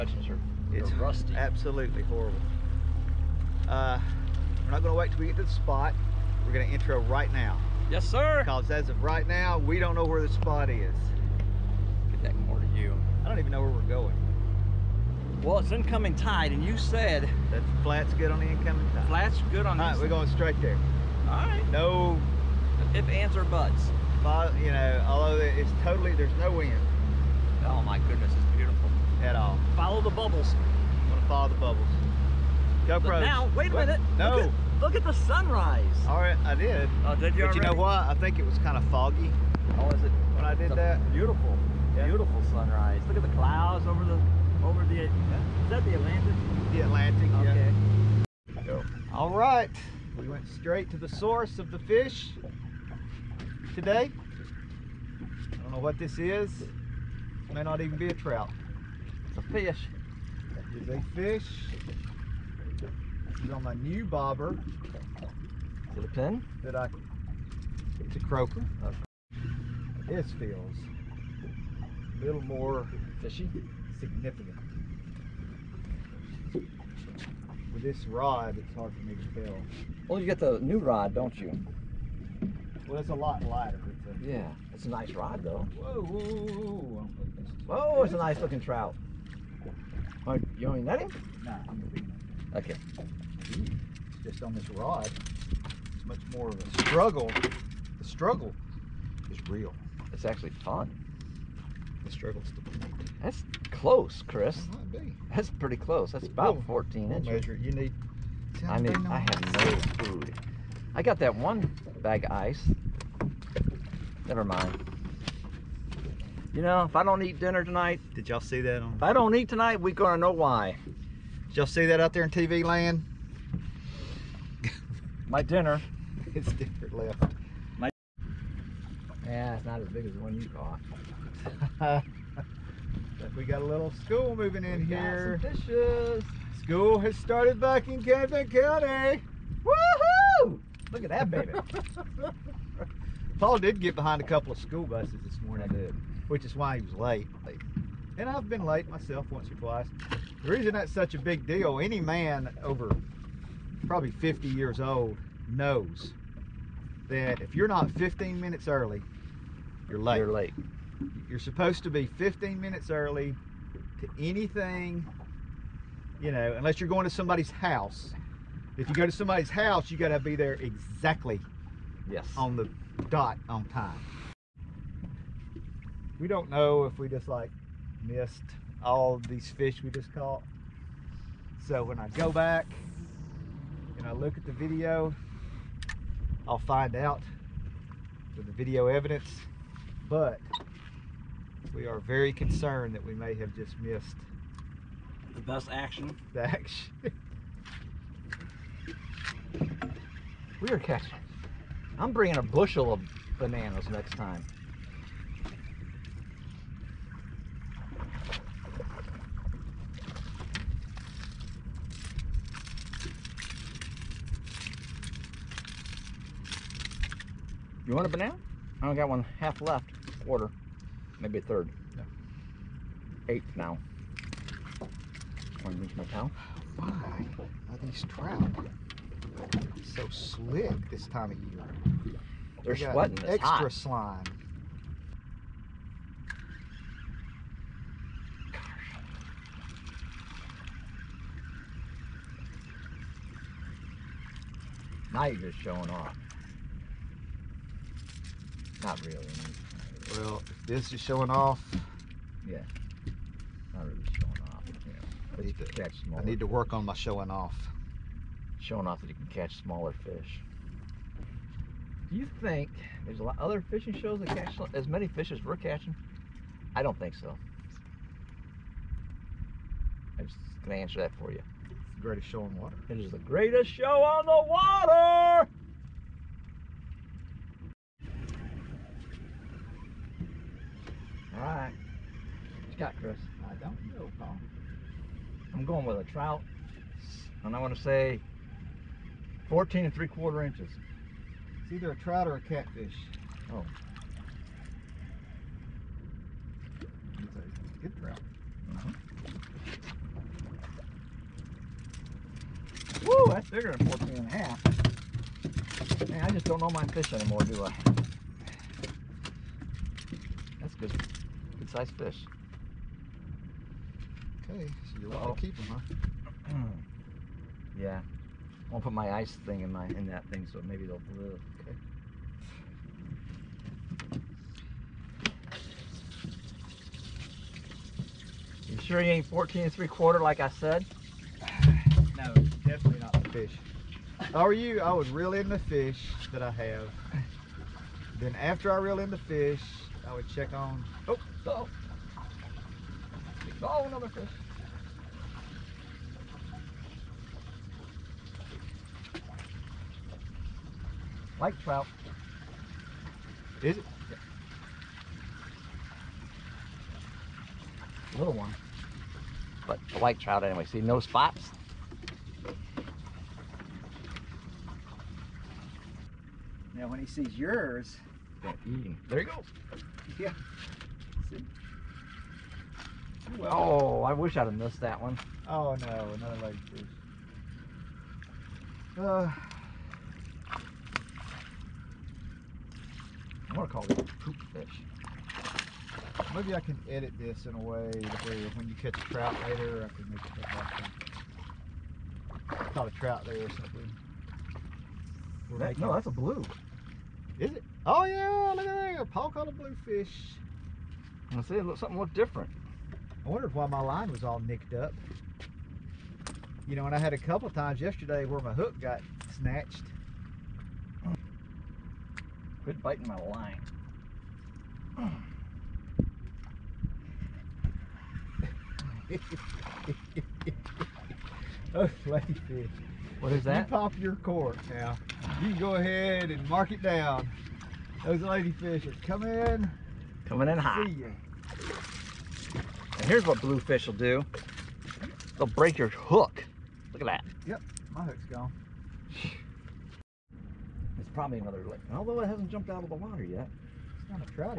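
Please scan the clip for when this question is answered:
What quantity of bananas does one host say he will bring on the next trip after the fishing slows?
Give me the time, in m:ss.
3:22.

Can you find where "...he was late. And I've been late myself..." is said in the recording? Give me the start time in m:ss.
2:26.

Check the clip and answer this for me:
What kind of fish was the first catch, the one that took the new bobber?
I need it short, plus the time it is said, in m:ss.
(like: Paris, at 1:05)
Croaker, at 1:08.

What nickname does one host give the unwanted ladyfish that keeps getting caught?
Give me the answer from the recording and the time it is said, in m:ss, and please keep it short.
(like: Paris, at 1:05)
Poop fish, at 6:24.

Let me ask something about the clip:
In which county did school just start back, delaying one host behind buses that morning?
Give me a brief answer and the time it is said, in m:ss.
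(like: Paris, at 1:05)
Camden County, at 2:18.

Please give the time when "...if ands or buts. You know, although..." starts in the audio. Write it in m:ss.
0:22.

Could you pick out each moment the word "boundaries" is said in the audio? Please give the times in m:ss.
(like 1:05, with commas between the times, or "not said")
not said.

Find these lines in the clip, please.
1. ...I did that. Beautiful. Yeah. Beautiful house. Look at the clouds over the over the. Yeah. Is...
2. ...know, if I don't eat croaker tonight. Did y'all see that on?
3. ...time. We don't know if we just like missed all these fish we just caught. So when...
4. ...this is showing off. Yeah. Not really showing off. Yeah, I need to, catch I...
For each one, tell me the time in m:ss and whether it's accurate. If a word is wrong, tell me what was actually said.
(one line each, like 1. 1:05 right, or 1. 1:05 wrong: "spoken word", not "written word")
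1. 0:40 wrong: "sunrise", not "house"
2. 1:56 wrong: "dinner", not "croaker"
3. 2:53 right
4. 4:10 right.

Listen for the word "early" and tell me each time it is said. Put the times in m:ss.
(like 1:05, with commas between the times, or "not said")
2:38, 2:42.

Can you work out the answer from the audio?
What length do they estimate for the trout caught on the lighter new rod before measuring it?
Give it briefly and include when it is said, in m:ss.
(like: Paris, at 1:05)
14 inches, at 1:46.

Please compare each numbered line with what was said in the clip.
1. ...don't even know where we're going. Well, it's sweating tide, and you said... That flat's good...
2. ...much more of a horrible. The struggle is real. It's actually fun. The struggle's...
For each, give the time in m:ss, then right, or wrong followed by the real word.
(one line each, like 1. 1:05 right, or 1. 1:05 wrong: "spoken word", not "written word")
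1. 0:13 wrong: "incoming", not "sweating"
2. 1:36 wrong: "struggle", not "horrible".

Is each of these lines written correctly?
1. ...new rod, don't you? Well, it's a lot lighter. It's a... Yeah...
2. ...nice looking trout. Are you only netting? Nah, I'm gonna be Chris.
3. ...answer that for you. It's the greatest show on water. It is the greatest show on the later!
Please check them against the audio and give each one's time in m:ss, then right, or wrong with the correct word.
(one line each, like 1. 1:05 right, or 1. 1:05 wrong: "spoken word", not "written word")
1. 1:20 right
2. 1:28 wrong: "Okay", not "Chris"
3. 4:30 wrong: "water", not "later".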